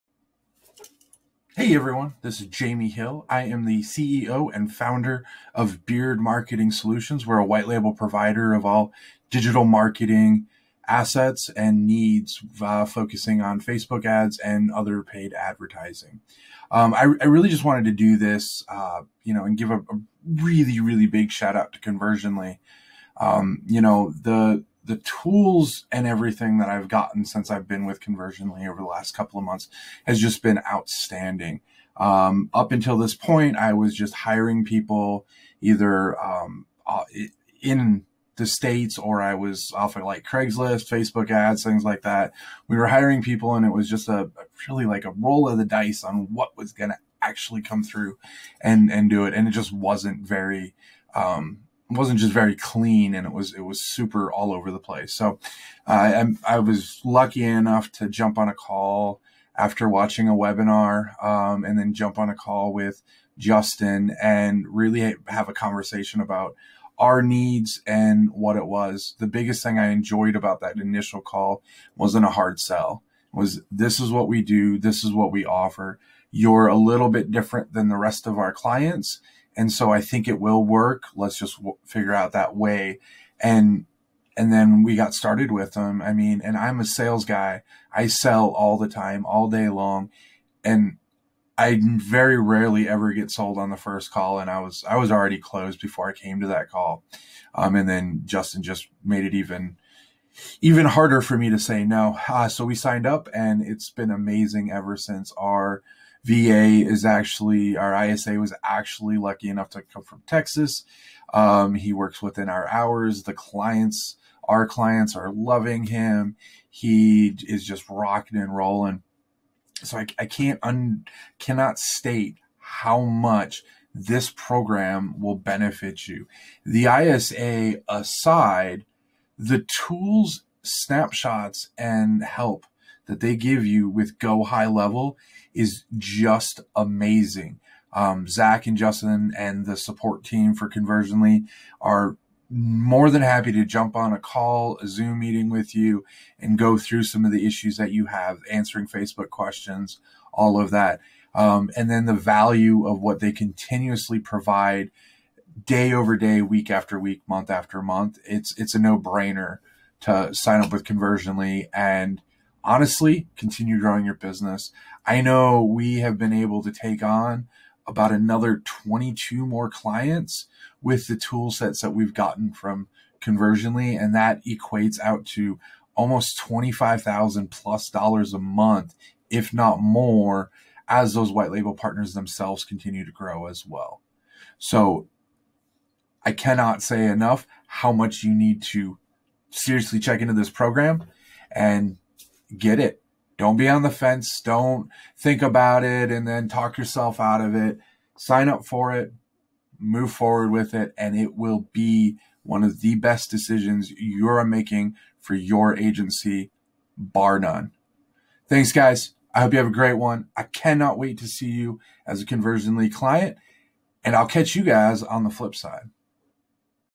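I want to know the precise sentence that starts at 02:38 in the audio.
It's it's a no brainer to sign up with Conversionly and honestly, continue growing your business.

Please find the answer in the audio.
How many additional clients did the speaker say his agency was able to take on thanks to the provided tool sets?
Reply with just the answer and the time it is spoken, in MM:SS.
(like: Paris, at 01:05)
22, at 02:48.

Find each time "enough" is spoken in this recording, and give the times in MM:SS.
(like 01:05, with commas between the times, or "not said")
00:57, 01:49, 03:07.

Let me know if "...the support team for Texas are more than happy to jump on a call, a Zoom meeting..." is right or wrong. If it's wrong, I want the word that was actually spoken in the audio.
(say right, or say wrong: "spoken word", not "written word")
wrong: "Conversionly", not "Texas".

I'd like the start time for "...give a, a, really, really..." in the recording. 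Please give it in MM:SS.
00:19.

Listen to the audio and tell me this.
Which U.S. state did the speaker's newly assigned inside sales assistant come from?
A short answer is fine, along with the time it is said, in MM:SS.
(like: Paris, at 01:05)
Texas, at 01:50.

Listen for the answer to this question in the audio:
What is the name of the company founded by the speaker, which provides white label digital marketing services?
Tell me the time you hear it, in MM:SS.
00:05.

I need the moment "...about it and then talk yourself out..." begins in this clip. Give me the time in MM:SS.
03:15.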